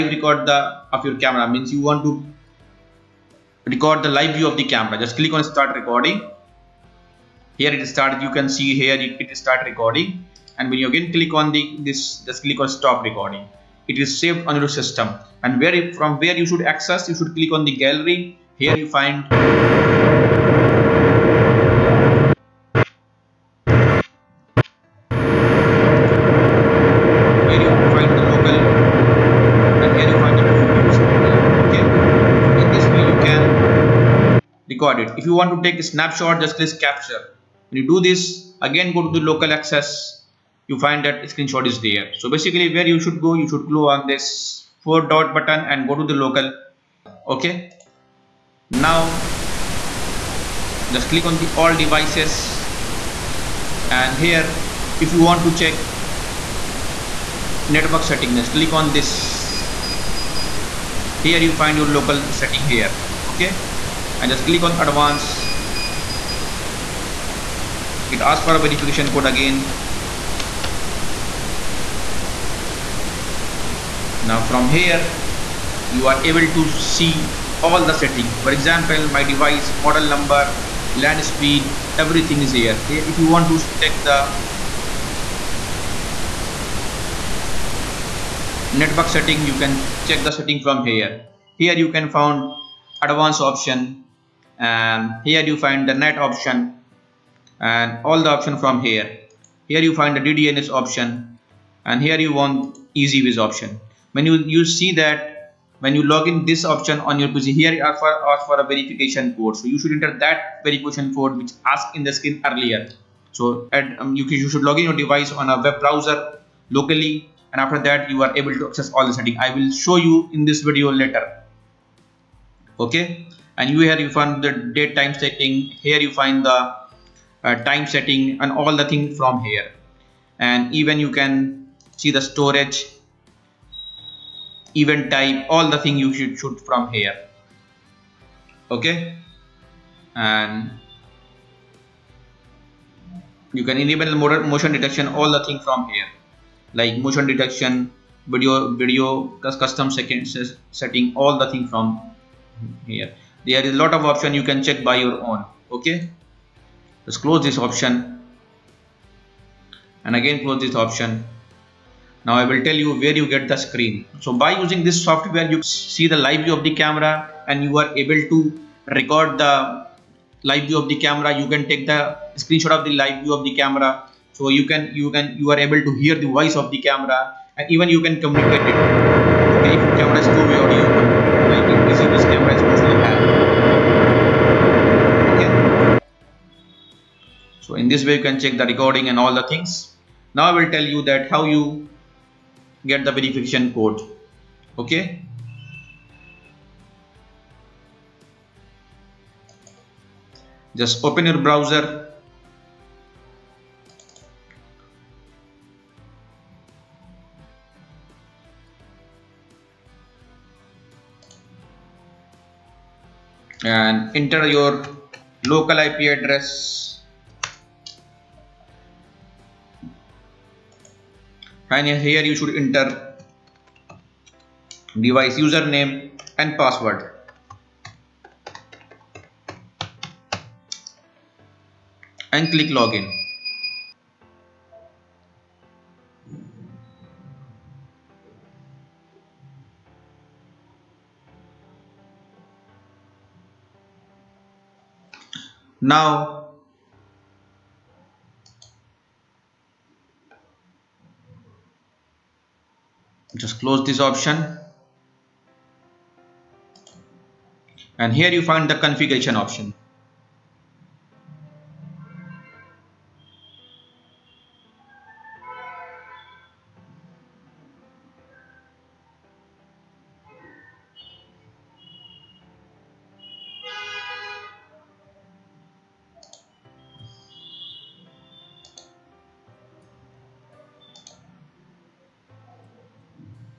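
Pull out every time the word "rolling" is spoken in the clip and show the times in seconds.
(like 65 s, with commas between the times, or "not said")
not said.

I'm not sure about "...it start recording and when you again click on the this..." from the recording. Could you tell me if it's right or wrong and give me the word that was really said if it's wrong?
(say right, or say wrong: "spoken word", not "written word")
right.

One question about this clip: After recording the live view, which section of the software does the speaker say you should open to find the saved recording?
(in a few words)
Gallery.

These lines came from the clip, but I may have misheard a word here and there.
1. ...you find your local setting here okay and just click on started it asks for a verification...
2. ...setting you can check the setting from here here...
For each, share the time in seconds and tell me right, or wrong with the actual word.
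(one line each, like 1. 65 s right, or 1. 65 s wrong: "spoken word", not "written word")
1. 61 s wrong: "advanced", not "started"
2. 89 s right.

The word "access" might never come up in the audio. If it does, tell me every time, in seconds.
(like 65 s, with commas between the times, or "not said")
16 s, 39 s, 118 s.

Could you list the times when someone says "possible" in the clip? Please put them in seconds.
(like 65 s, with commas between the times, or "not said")
182 s.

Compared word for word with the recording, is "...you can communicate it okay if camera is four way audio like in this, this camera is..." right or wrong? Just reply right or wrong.
wrong.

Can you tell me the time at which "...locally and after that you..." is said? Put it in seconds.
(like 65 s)
116 s.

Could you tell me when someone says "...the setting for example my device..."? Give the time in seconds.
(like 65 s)
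77 s.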